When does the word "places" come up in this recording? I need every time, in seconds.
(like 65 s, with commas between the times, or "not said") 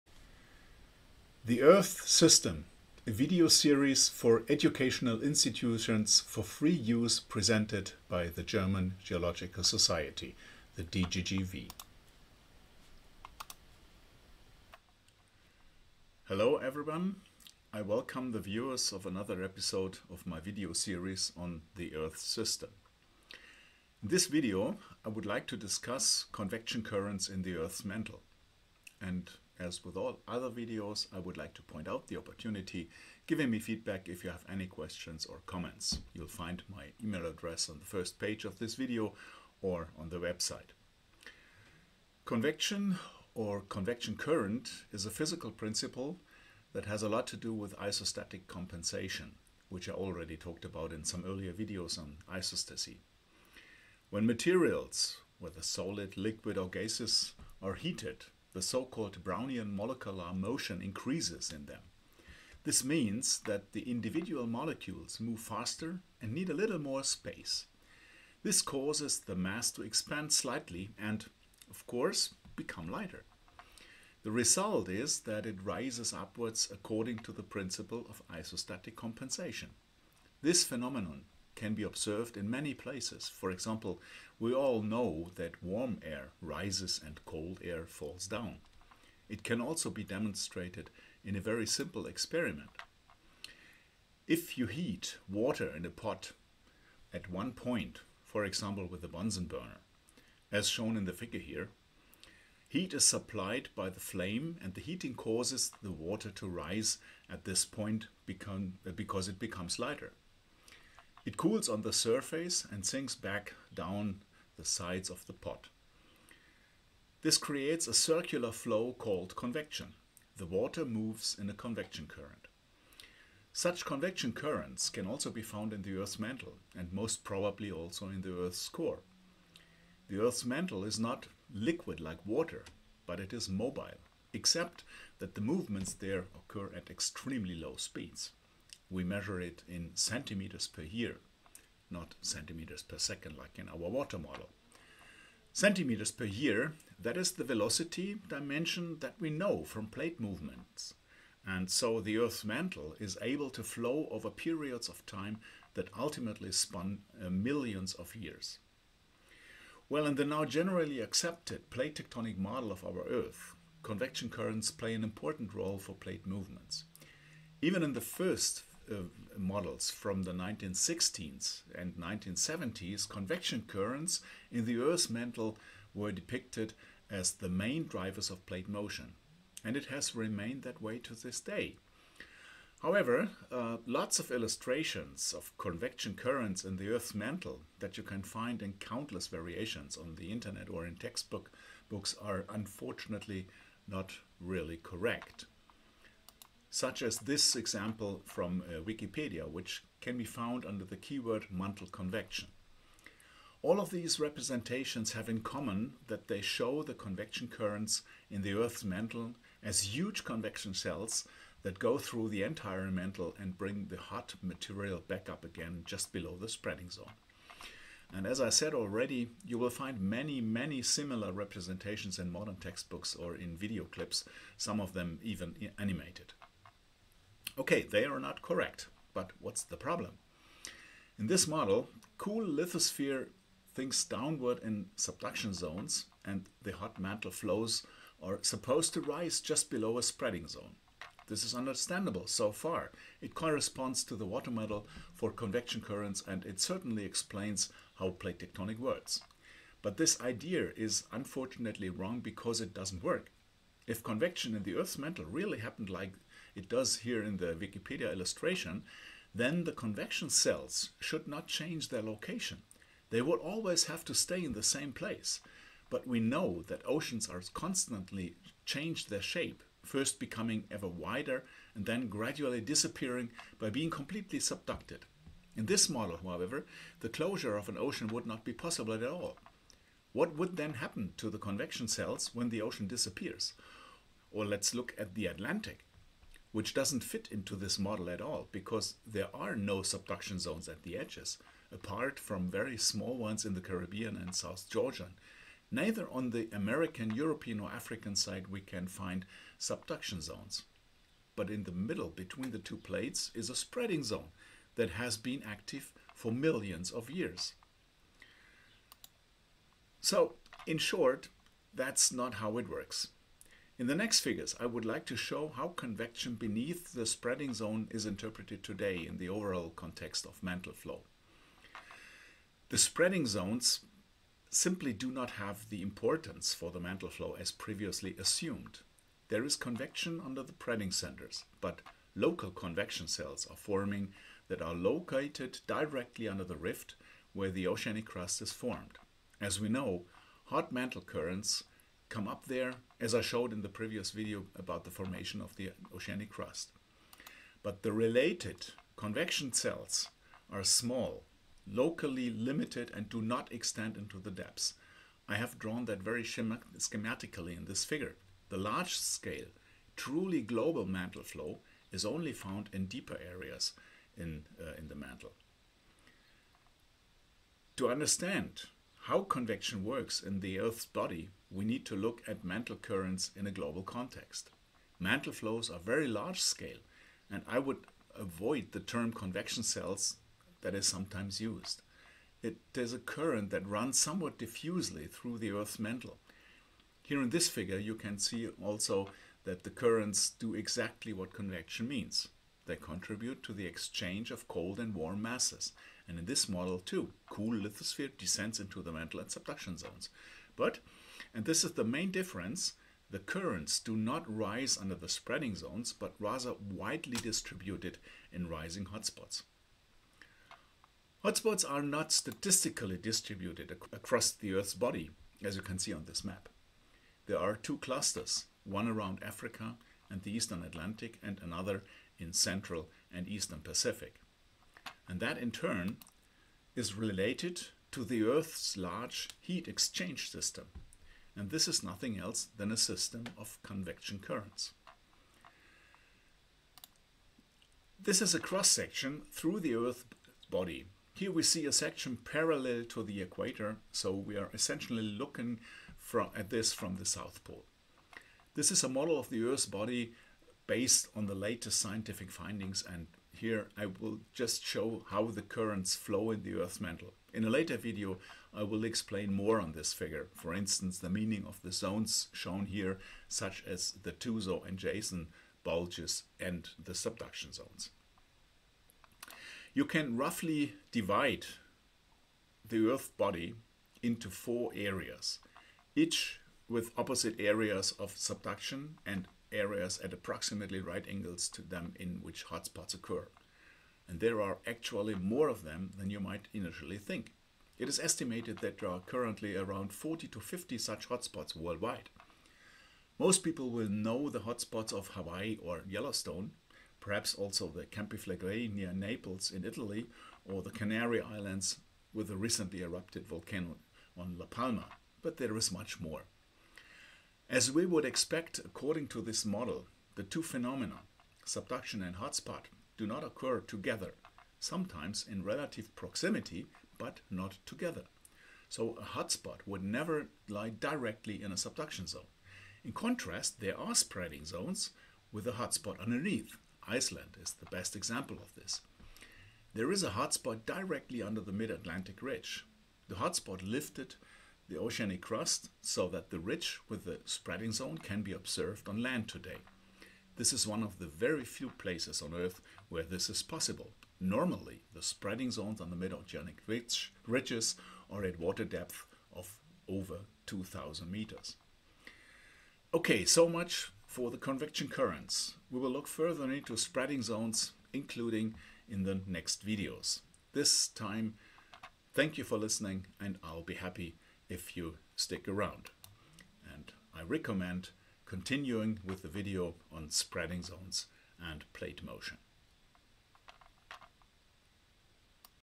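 82 s, 264 s, 541 s.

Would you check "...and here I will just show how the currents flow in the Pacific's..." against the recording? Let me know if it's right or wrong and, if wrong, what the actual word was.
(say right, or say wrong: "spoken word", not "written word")
wrong: "Earth", not "Pacific".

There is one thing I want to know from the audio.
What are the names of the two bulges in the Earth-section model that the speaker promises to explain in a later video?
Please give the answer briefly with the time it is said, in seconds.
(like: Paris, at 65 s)
Tuzo and Jason, at 464 s.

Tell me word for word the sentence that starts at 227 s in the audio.
Okay, they are not correct, but what's the problem?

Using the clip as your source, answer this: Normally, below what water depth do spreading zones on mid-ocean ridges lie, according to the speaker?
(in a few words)
2,000 meters.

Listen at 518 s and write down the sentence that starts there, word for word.
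So a hotspot would never lie directly in a subduction zone.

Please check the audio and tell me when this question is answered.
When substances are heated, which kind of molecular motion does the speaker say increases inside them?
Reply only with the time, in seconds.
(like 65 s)
59 s.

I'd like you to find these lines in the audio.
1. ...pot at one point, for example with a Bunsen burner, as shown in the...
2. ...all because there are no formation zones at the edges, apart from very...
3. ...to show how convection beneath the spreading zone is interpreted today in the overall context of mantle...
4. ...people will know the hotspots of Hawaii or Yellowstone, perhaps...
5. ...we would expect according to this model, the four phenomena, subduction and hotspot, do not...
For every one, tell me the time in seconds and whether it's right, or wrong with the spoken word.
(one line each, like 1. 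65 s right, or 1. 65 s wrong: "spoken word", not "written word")
1. 95 s right
2. 288 s wrong: "subduction", not "formation"
3. 315 s right
4. 493 s right
5. 507 s wrong: "two", not "four".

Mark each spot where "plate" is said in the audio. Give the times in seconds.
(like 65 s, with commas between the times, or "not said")
149 s, 161 s, 165 s, 178 s, 248 s, 302 s, 571 s.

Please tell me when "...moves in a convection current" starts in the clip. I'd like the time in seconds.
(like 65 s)
120 s.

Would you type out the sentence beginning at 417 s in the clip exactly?
There are two clusters, one around Africa and the Eastern Atlantic and another in Central and Eastern Pacific.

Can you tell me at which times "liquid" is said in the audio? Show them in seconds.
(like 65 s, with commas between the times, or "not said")
56 s, 131 s.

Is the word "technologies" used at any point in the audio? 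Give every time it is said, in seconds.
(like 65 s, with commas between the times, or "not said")
not said.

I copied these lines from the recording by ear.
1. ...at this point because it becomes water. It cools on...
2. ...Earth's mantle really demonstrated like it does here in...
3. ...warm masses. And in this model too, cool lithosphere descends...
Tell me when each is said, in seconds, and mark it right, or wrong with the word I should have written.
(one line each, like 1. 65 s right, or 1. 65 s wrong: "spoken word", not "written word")
1. 107 s wrong: "lighter", not "water"
2. 254 s wrong: "happened", not "demonstrated"
3. 394 s right.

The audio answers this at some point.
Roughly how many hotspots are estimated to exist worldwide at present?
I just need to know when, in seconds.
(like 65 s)
489 s.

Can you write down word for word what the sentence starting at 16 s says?
Hello everyone, I welcome the viewers of another episode of my video series on the Earth System.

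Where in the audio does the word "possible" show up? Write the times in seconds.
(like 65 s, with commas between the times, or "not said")
278 s, 543 s.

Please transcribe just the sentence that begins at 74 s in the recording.
The result is that it rises upwards according to the principle of isostatic compensation.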